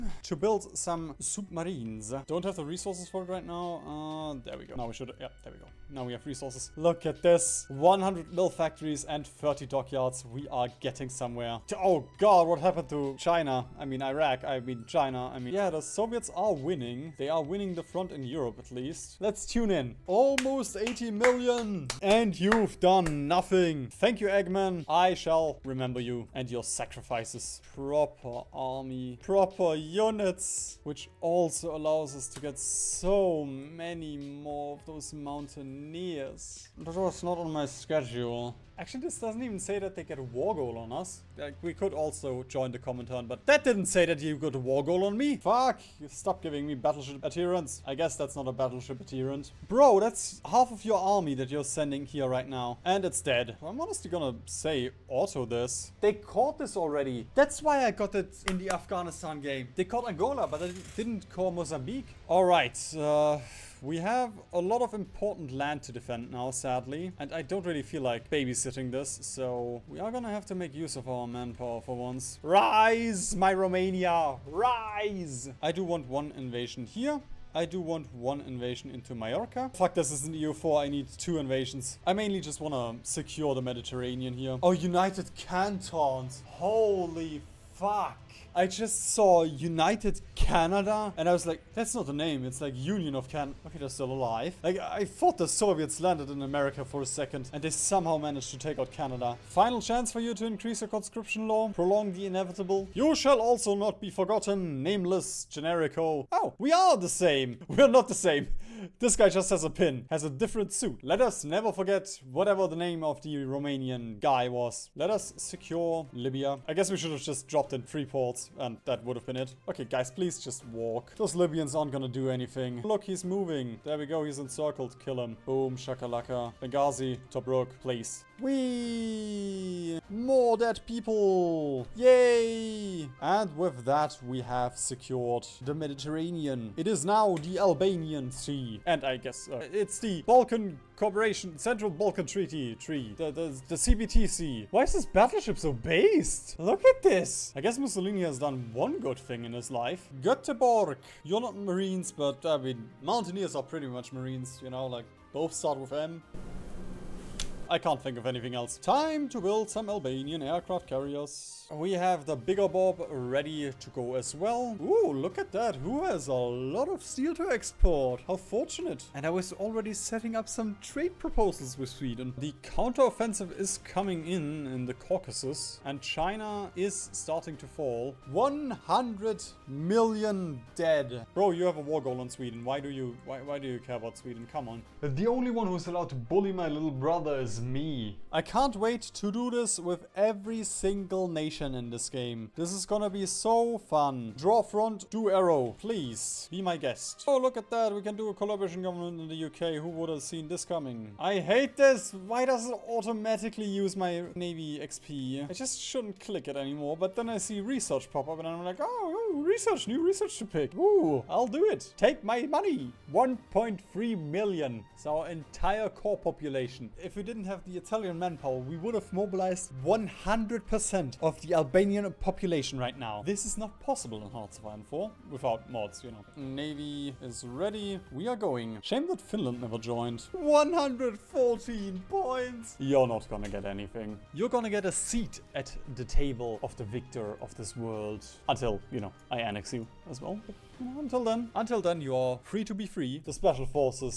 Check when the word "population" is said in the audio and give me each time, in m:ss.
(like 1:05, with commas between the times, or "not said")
3:36, 3:42.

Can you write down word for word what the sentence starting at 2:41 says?
We have the bigger bob ready to go as well.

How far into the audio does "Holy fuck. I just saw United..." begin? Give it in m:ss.
1:26.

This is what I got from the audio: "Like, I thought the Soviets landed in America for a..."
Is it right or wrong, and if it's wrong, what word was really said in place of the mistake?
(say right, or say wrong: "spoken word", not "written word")
right.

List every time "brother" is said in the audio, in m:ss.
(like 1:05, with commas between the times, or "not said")
3:06.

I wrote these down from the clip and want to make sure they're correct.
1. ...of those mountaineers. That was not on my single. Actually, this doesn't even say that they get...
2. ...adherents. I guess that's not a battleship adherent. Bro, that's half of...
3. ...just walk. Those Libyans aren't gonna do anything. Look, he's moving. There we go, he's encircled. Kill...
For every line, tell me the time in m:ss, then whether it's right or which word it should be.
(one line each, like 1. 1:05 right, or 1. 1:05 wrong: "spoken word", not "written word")
1. 0:34 wrong: "schedule", not "single"
2. 0:47 right
3. 2:00 right.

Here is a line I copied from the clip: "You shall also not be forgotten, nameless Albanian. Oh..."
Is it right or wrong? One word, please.
wrong.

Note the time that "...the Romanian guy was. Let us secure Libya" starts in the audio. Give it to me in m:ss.
1:53.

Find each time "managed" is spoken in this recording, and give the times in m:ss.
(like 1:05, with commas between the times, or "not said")
1:38.